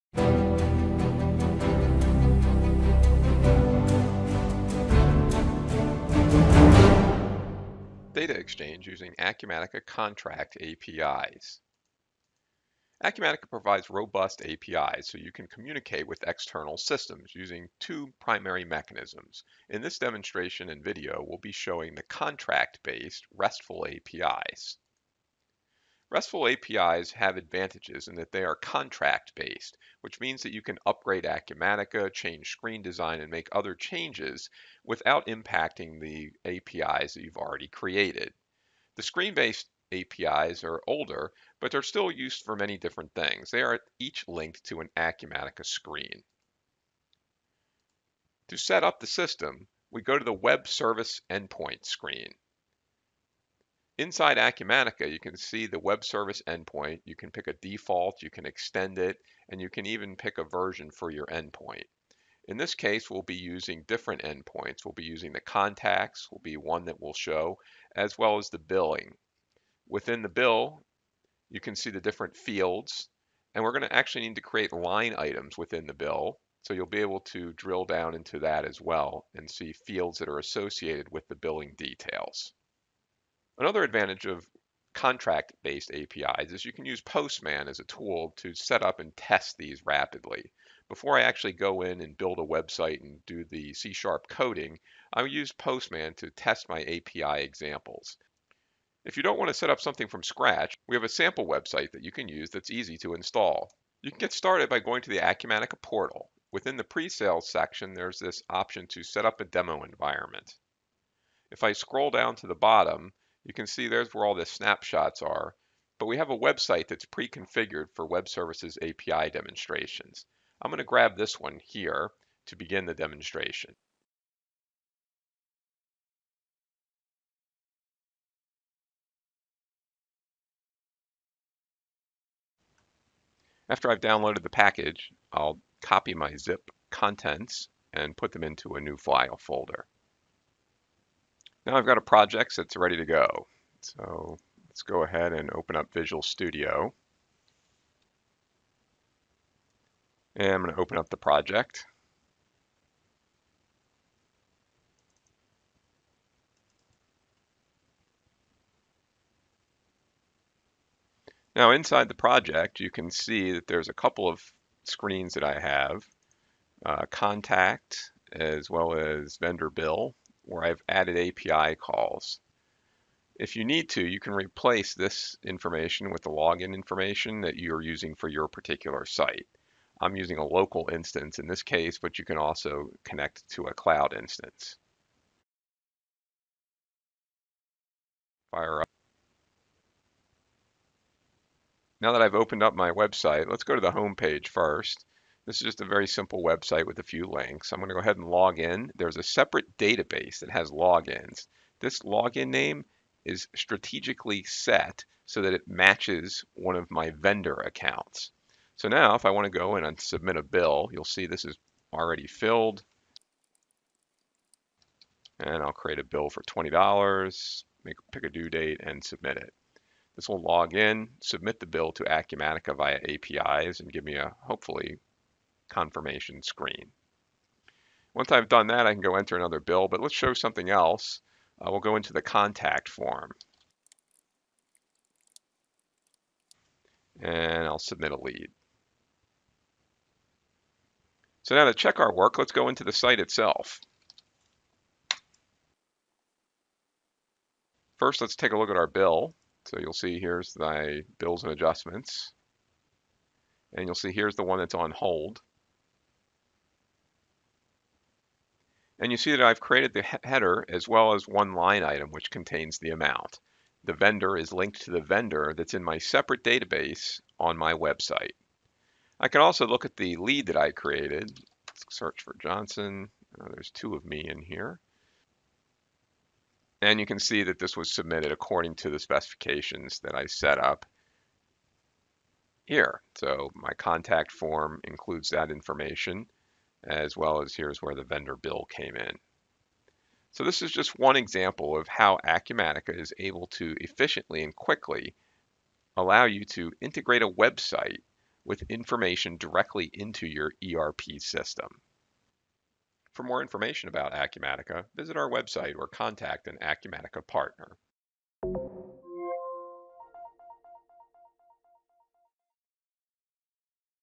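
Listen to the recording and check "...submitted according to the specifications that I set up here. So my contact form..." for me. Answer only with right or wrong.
right.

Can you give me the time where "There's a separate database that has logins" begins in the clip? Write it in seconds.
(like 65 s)
198 s.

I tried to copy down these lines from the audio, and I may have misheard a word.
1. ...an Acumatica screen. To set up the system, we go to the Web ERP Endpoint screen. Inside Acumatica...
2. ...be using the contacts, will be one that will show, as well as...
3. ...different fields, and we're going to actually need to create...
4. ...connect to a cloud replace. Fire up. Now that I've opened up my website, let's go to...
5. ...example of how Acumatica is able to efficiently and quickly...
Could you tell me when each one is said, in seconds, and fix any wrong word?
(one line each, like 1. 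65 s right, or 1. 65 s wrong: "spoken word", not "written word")
1. 44 s wrong: "Service", not "ERP"
2. 64 s right
3. 72 s right
4. 183 s wrong: "instance", not "replace"
5. 291 s right.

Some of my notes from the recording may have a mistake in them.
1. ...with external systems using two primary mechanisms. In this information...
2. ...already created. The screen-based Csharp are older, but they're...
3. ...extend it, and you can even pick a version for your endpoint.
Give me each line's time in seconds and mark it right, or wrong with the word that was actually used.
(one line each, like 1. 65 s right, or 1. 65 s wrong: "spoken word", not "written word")
1. 16 s wrong: "demonstration", not "information"
2. 37 s wrong: "APIs", not "Csharp"
3. 58 s right.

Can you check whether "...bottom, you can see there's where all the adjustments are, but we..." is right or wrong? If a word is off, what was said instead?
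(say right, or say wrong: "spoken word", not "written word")
wrong: "snapshots", not "adjustments".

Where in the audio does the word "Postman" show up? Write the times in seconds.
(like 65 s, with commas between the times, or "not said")
86 s, 95 s.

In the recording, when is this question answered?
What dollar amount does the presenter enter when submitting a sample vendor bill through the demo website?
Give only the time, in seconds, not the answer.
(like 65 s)
216 s.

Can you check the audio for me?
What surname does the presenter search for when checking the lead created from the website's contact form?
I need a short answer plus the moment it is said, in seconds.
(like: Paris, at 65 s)
Johnson, at 272 s.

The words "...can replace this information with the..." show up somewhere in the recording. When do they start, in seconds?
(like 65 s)
174 s.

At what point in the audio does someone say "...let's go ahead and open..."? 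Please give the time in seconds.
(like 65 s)
144 s.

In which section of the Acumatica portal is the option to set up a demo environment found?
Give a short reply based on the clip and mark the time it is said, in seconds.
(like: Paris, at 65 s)
pre-sales, at 106 s.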